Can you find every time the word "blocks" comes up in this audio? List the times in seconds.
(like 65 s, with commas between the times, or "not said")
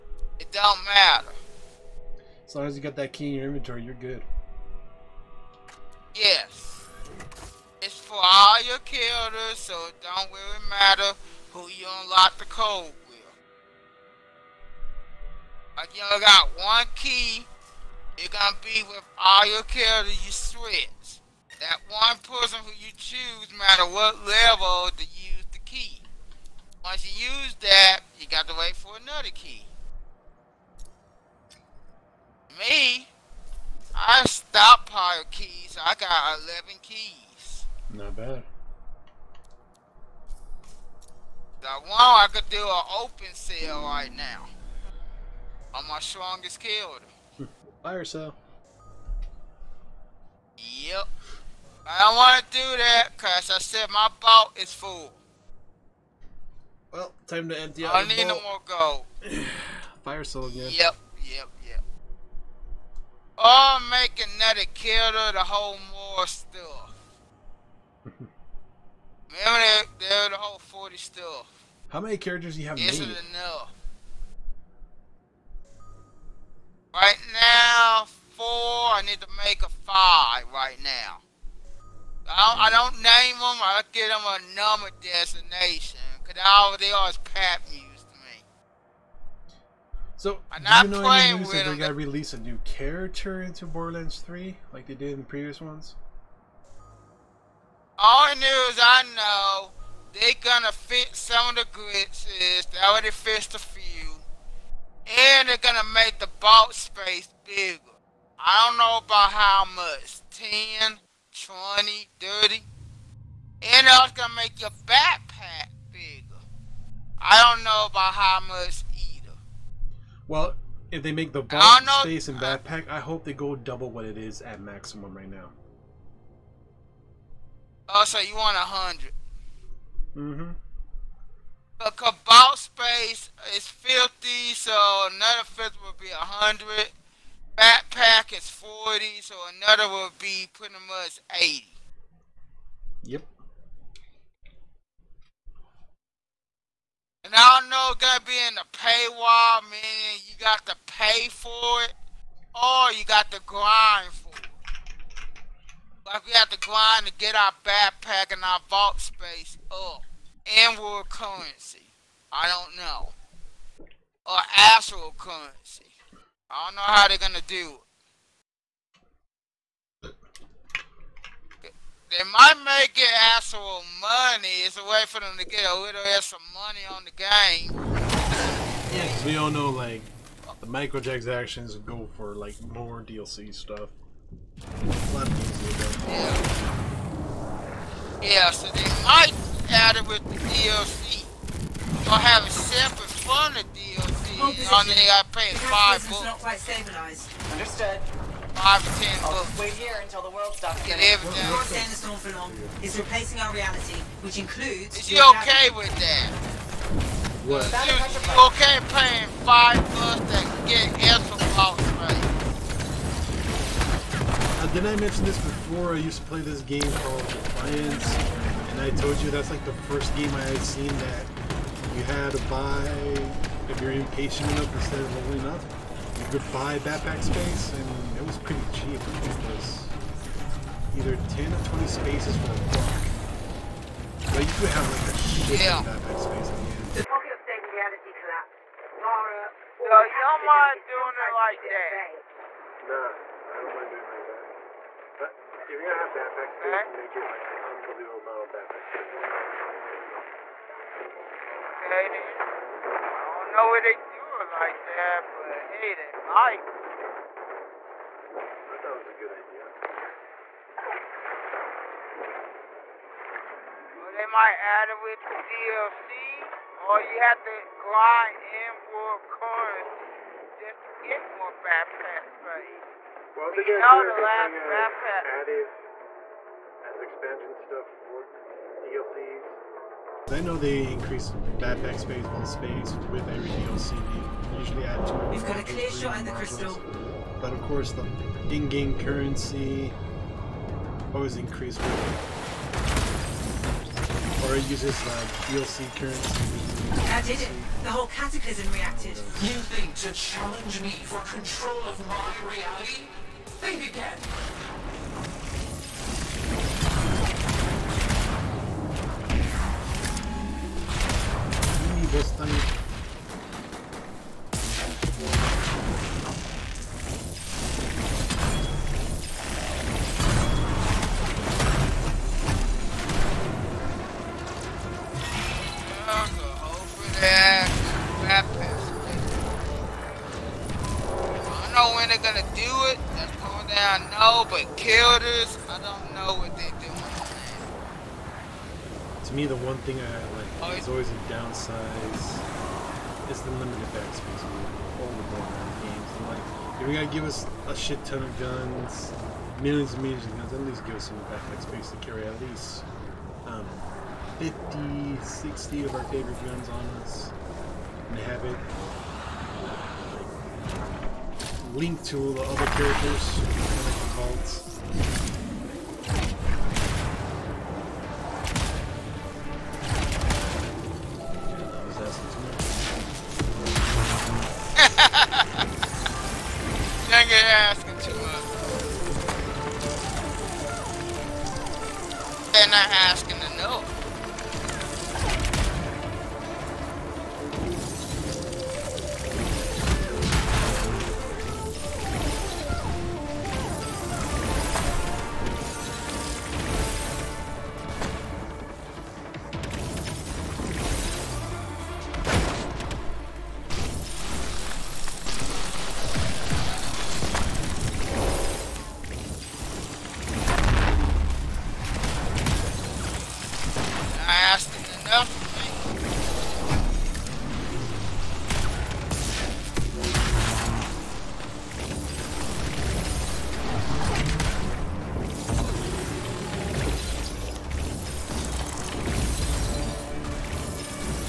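211 s, 232 s.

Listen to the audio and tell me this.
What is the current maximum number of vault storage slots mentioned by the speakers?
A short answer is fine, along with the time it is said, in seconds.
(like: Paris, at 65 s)
50, at 133 s.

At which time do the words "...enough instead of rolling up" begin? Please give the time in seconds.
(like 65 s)
224 s.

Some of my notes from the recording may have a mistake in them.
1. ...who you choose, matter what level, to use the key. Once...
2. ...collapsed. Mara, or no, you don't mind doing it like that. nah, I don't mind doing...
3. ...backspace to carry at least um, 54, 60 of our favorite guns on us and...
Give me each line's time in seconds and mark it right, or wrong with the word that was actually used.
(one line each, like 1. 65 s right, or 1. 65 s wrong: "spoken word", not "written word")
1. 22 s right
2. 238 s right
3. 351 s wrong: "50", not "54".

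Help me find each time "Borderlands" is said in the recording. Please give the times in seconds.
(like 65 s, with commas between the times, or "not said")
93 s, 345 s.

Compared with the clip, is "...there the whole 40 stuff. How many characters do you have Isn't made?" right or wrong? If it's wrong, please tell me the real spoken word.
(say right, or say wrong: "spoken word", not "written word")
right.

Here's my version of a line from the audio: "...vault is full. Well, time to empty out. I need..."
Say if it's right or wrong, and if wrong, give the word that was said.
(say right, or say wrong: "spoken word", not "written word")
right.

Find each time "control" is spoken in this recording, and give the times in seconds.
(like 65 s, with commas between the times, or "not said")
301 s.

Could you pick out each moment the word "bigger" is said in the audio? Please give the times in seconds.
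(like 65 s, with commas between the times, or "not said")
107 s, 115 s.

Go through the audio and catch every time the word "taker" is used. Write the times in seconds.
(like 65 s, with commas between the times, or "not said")
not said.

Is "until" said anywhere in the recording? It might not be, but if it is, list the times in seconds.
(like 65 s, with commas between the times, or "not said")
200 s.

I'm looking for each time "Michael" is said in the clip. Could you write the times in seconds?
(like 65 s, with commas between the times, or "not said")
not said.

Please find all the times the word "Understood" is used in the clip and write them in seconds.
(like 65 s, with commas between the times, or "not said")
197 s.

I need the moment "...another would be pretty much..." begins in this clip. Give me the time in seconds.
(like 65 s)
139 s.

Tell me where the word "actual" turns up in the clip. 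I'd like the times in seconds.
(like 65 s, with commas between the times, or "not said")
164 s, 173 s.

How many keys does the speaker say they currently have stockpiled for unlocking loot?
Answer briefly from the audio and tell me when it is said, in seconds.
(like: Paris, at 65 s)
11, at 36 s.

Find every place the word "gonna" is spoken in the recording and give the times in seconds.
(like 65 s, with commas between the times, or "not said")
18 s, 100 s, 105 s, 114 s, 167 s, 245 s.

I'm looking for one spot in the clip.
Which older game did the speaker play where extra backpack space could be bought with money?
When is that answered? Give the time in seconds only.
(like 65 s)
217 s.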